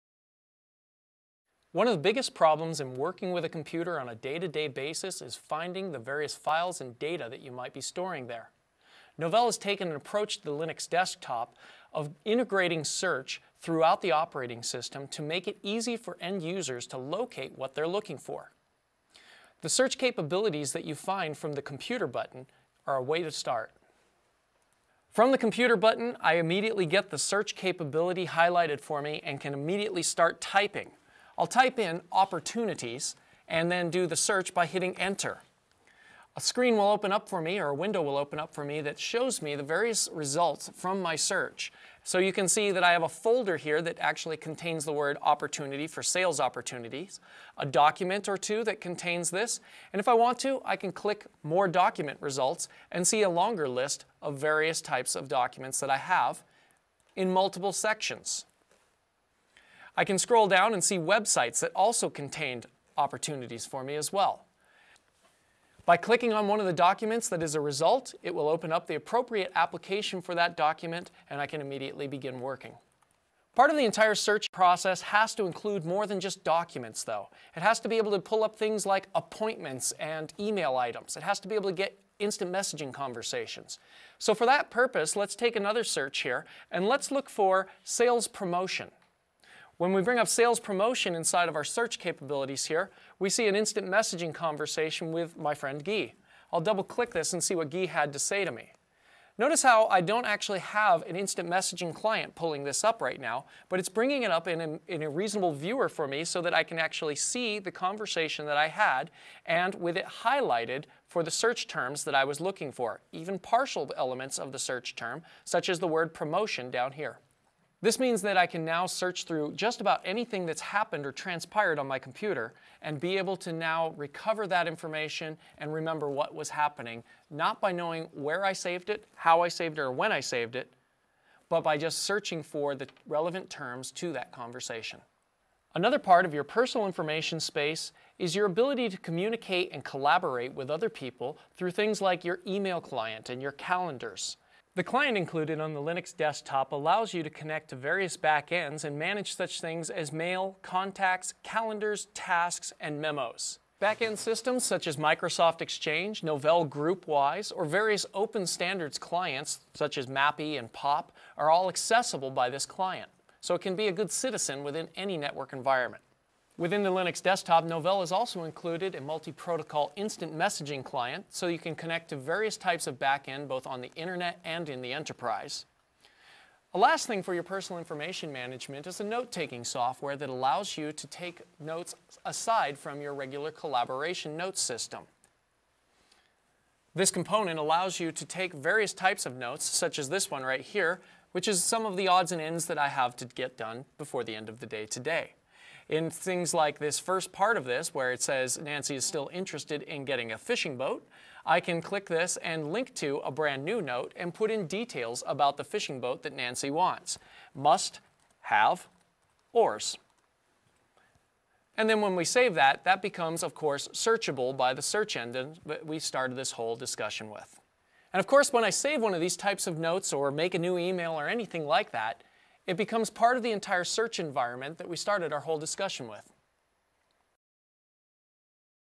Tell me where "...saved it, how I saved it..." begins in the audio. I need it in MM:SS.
02:08.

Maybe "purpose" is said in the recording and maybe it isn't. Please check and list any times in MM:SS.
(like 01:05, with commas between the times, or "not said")
01:24.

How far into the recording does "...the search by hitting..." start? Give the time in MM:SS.
00:34.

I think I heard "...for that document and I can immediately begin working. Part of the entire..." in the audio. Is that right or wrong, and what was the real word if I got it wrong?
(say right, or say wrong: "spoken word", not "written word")
right.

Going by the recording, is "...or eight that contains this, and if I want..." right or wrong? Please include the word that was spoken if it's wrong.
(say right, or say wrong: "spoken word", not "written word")
wrong: "two", not "eight".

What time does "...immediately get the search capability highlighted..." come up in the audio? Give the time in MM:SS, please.
00:26.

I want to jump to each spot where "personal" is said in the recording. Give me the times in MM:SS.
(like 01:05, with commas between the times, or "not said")
02:16, 02:57.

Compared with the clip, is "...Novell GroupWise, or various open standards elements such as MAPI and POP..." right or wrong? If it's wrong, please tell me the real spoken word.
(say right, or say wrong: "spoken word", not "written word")
wrong: "clients", not "elements".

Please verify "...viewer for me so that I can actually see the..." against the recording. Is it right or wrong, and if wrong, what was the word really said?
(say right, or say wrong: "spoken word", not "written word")
right.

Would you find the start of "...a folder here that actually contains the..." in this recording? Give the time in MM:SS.
00:43.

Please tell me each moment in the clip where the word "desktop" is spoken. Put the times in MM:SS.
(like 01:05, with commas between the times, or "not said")
00:10, 02:26, 02:47.